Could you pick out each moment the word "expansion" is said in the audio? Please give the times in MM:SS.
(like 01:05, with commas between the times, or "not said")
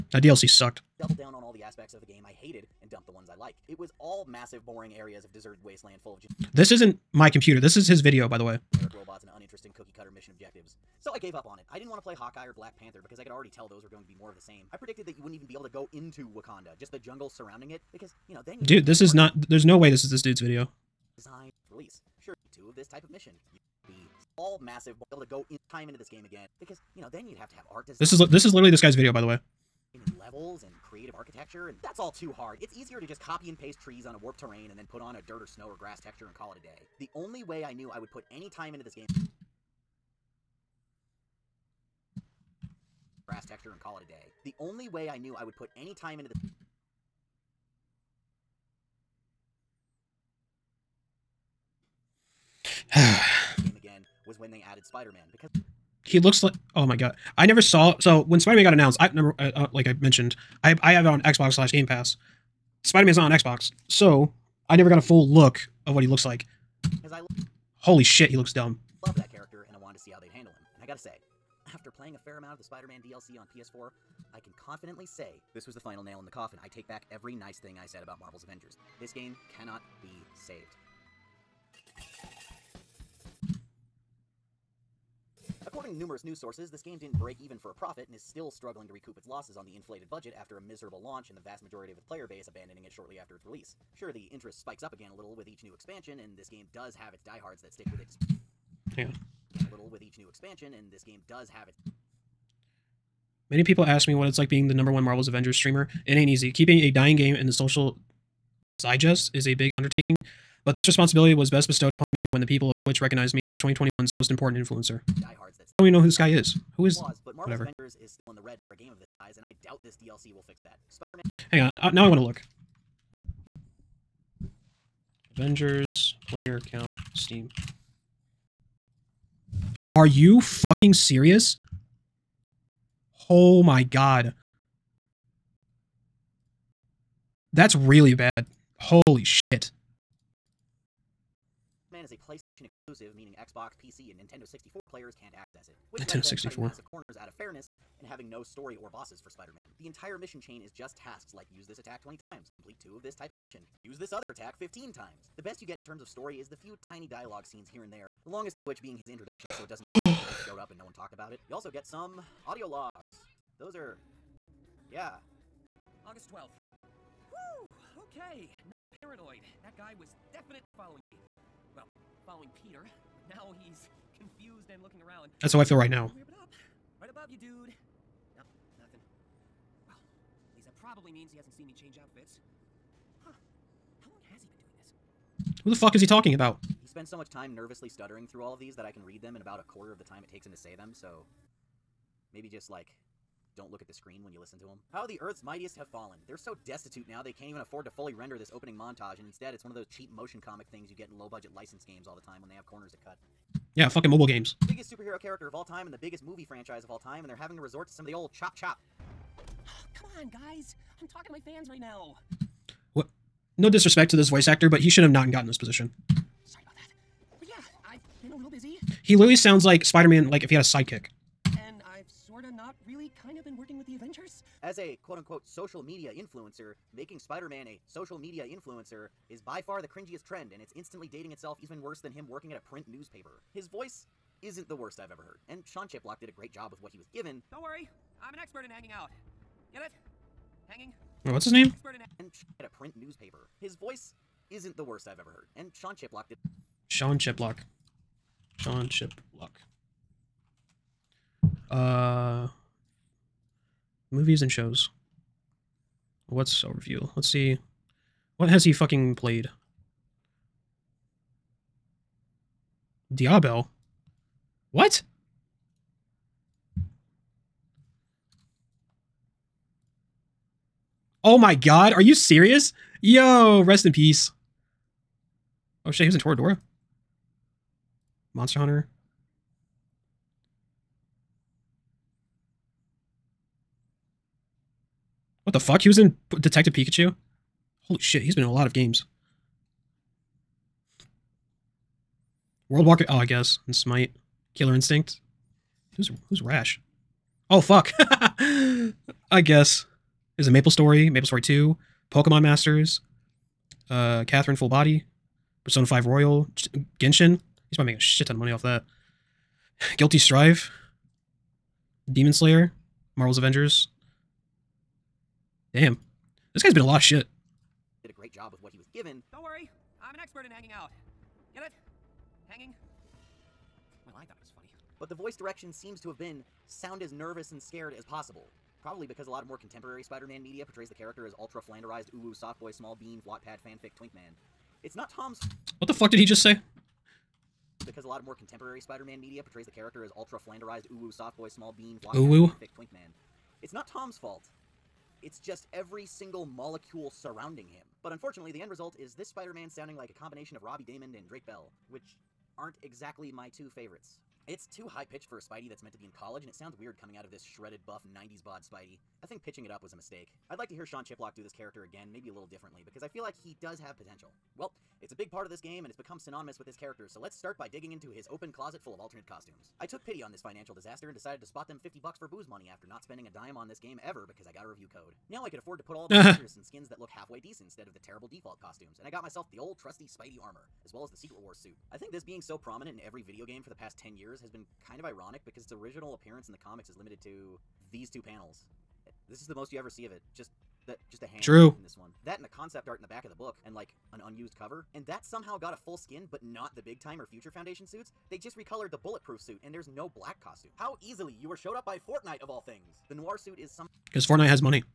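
01:35, 01:40.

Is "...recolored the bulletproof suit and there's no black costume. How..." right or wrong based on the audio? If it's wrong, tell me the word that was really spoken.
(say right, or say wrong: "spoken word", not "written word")
right.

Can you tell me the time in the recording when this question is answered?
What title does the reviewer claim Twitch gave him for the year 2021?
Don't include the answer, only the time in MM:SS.
01:54.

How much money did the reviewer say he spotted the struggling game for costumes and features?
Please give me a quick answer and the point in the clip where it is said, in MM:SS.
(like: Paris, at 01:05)
50 bucks, at 06:11.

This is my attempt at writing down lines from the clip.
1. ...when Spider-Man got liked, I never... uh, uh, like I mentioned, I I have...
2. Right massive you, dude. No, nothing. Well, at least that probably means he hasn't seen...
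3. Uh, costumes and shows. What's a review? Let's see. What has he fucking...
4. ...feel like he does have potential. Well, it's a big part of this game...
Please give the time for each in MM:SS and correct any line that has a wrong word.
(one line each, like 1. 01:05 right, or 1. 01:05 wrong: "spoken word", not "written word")
1. 00:58 wrong: "announced", not "liked"
2. 02:57 wrong: "above", not "massive"
3. 04:11 wrong: "movies", not "costumes"
4. 06:03 right.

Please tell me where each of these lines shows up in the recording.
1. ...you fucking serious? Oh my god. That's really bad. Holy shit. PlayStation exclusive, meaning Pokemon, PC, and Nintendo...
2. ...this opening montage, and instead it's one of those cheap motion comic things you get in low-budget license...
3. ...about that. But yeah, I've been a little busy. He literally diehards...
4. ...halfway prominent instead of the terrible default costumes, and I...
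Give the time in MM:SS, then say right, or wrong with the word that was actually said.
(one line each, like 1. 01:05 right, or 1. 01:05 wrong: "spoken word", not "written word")
1. 02:10 wrong: "Xbox", not "Pokemon"
2. 03:18 right
3. 03:36 wrong: "sounds", not "diehards"
4. 06:17 wrong: "decent", not "prominent".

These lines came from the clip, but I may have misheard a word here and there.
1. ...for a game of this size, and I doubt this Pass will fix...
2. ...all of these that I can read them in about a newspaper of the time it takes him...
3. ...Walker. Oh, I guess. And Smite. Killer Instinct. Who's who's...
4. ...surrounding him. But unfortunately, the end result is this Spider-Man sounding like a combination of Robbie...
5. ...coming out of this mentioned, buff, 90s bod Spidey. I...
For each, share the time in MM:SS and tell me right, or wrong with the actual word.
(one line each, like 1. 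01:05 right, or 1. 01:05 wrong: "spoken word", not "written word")
1. 01:58 wrong: "DLC", not "Pass"
2. 03:08 wrong: "quarter", not "newspaper"
3. 04:52 right
4. 05:47 right
5. 05:56 wrong: "shredded", not "mentioned".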